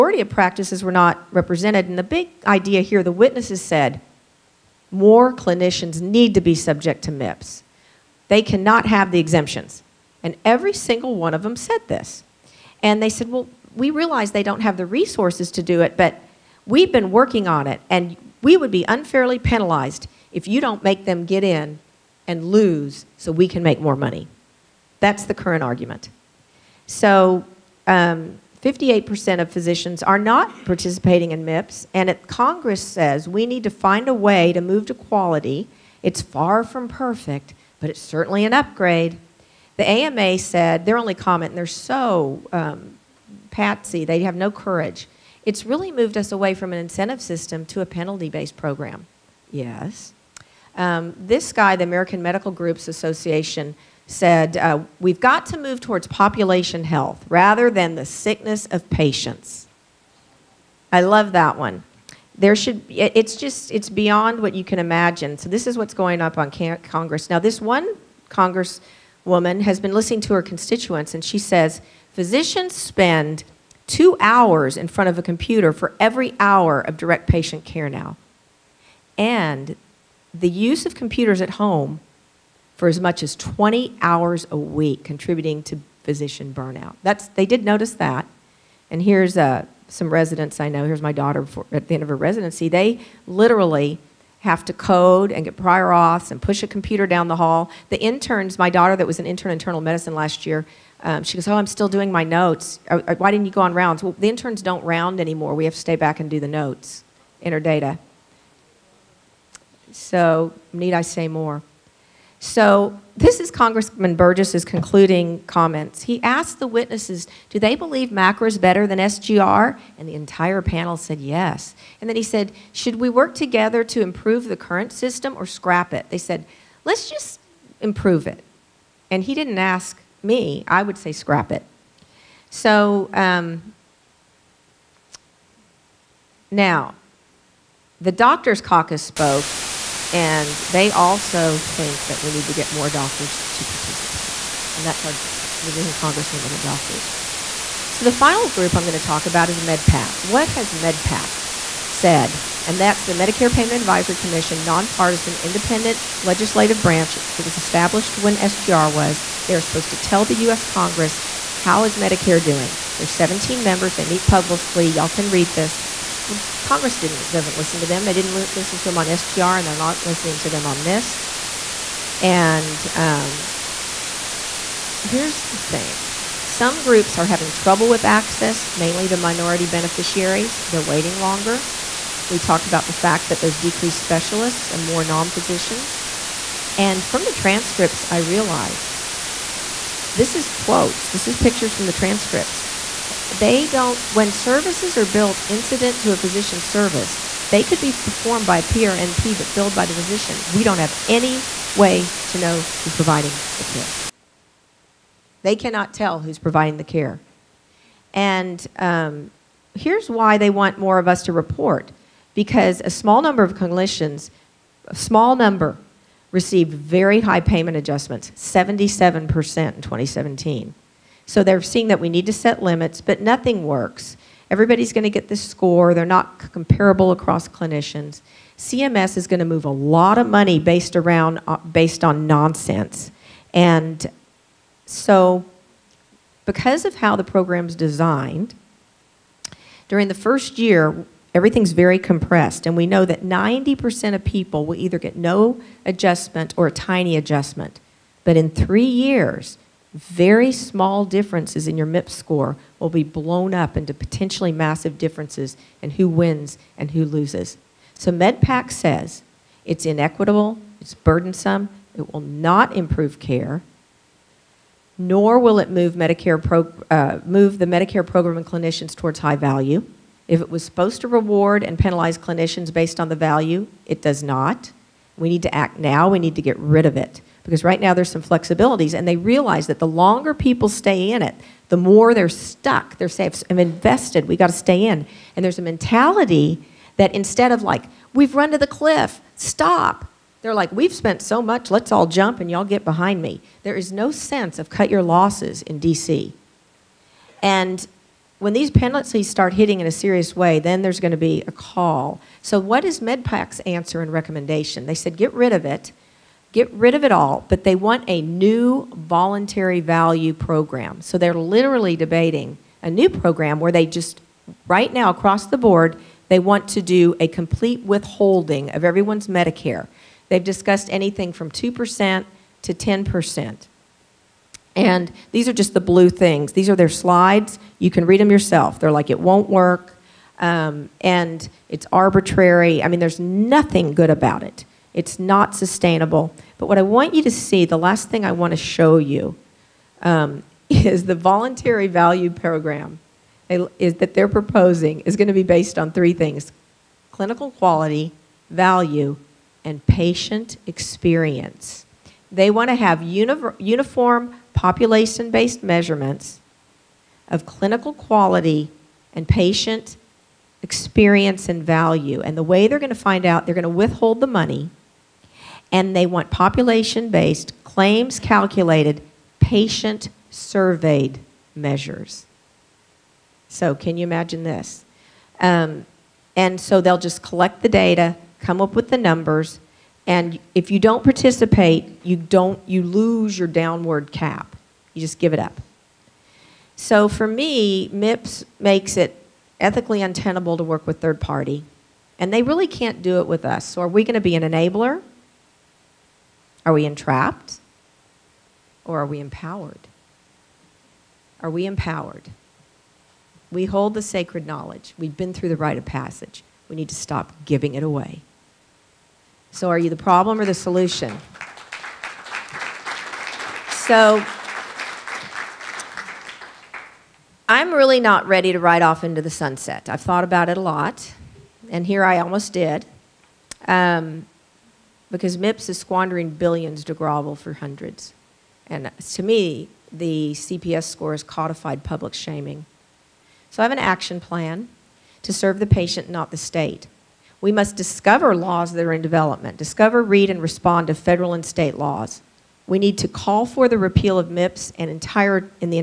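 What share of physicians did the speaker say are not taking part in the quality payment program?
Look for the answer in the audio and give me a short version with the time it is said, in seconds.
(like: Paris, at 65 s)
58%, at 27 s.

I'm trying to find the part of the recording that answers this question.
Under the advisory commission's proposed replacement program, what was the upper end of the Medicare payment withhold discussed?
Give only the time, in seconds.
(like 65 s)
322 s.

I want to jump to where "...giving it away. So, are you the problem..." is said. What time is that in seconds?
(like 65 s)
407 s.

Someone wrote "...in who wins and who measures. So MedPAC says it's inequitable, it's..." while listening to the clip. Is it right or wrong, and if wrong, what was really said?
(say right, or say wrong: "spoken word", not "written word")
wrong: "loses", not "measures".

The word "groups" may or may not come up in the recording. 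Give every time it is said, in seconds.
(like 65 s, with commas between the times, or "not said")
52 s, 148 s, 176 s.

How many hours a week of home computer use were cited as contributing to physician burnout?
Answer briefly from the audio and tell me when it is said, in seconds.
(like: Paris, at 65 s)
20, at 83 s.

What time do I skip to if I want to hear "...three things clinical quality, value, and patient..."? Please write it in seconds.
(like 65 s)
345 s.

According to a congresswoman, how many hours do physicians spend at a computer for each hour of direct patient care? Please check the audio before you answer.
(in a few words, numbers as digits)
2 hours.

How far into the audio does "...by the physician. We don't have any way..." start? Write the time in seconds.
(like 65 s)
199 s.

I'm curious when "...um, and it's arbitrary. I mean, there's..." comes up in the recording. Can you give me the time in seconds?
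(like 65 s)
330 s.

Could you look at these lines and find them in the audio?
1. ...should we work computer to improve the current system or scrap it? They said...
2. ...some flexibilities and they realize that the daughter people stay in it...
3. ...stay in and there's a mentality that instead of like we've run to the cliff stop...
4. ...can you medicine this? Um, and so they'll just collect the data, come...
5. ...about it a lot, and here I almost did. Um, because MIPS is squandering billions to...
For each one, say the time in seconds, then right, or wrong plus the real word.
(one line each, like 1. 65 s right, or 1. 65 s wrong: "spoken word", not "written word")
1. 122 s wrong: "together", not "computer"
2. 278 s wrong: "longer", not "daughter"
3. 284 s right
4. 373 s wrong: "imagine", not "medicine"
5. 420 s right.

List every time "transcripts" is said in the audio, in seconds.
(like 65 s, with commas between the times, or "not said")
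187 s, 191 s.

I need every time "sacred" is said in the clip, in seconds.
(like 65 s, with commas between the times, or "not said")
404 s.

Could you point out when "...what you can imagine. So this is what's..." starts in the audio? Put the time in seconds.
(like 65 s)
64 s.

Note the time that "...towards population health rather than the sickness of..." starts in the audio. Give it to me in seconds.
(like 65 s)
55 s.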